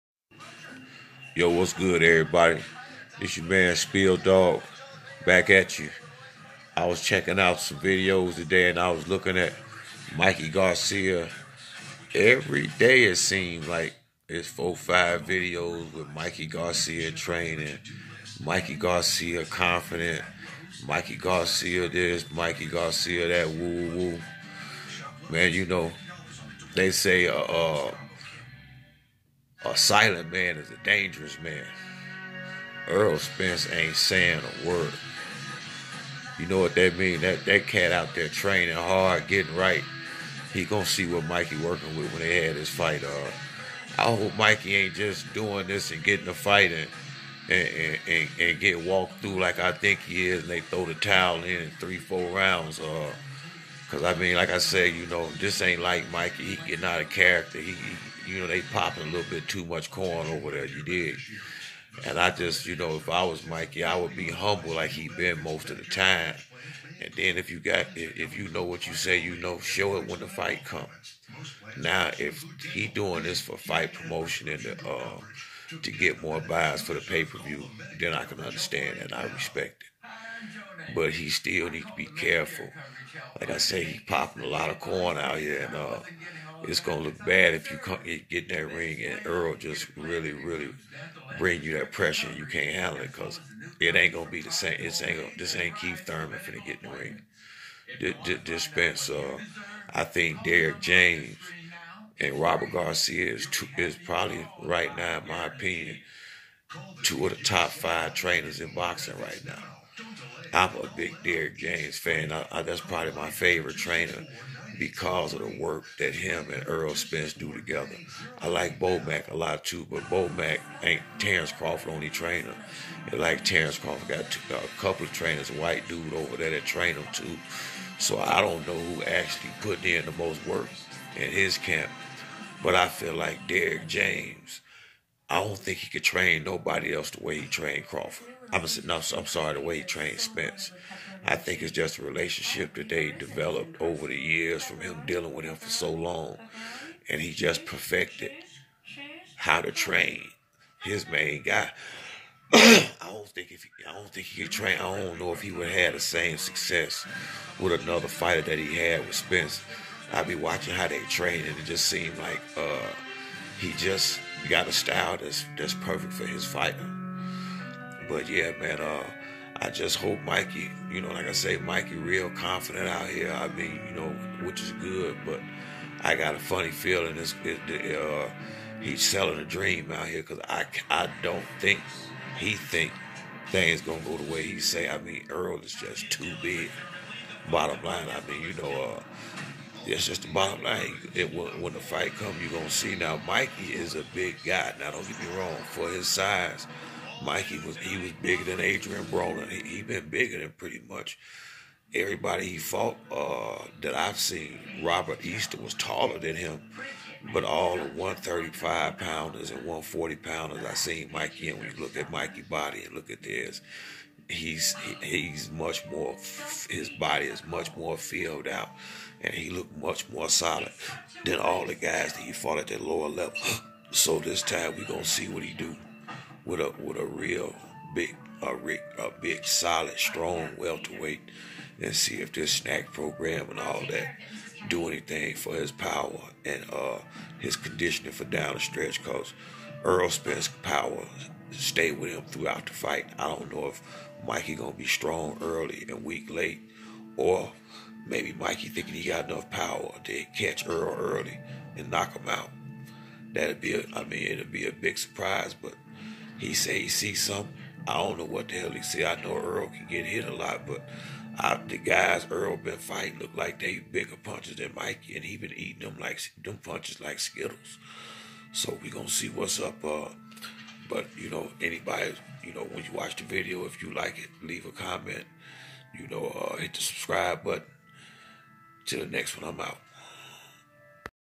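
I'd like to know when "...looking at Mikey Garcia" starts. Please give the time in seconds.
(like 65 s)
9 s.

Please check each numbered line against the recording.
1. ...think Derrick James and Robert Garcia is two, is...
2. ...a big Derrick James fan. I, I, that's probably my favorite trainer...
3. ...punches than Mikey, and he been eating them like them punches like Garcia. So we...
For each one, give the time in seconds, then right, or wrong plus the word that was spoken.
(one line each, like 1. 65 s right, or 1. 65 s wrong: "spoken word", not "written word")
1. 100 s right
2. 110 s right
3. 264 s wrong: "Skittles", not "Garcia".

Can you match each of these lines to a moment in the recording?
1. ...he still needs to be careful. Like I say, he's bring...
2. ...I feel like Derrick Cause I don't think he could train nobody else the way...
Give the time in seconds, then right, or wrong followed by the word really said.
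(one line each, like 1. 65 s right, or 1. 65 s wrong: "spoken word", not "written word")
1. 81 s wrong: "popping", not "bring"
2. 132 s wrong: "James", not "Cause".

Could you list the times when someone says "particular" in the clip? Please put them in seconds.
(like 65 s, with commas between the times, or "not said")
not said.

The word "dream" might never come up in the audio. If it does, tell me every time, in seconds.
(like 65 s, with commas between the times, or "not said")
179 s.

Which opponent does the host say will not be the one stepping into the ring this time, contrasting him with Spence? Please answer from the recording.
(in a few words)
Keith Thurman.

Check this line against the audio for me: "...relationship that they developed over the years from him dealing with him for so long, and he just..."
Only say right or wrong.
right.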